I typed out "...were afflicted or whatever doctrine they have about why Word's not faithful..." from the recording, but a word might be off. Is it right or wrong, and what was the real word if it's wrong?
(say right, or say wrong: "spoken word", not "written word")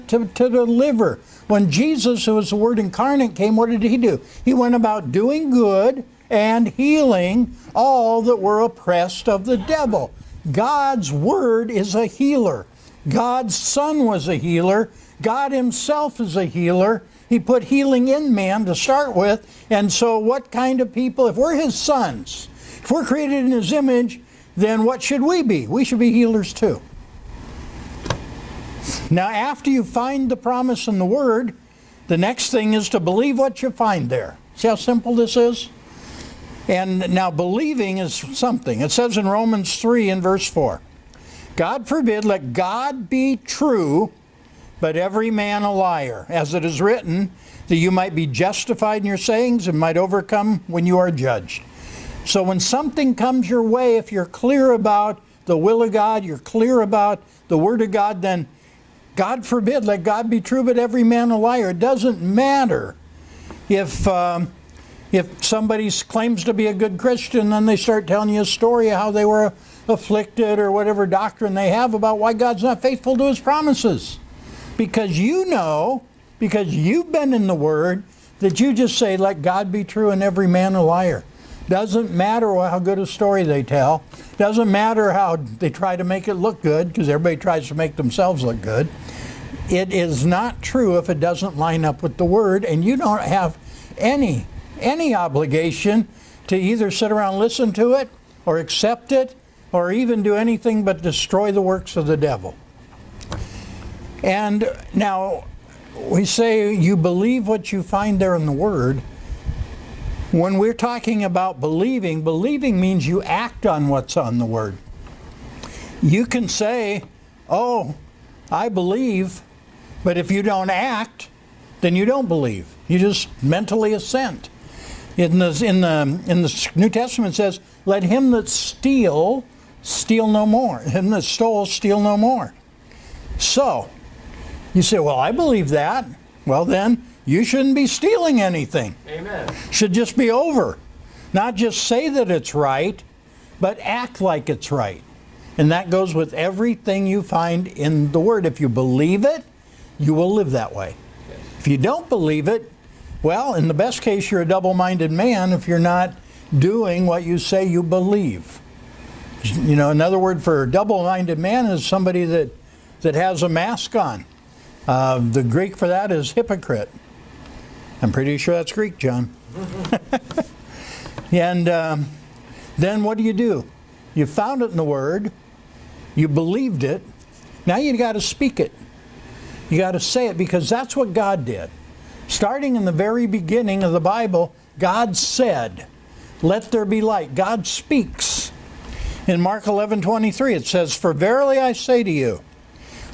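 wrong: "God", not "Word".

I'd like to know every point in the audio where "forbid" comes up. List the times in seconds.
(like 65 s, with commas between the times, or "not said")
41 s, 59 s.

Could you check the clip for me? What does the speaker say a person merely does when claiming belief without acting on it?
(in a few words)
mentally assent.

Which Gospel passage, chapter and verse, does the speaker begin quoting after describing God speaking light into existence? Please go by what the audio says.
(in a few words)
Mark 11:23.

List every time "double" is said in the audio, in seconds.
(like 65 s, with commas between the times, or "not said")
154 s, 160 s.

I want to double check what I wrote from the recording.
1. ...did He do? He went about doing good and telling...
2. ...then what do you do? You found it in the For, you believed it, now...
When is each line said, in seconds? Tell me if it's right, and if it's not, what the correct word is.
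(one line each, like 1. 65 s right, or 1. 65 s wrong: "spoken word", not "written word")
1. 3 s wrong: "healing", not "telling"
2. 172 s wrong: "Word", not "For".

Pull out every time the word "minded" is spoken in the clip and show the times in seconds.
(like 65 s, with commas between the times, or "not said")
154 s, 161 s.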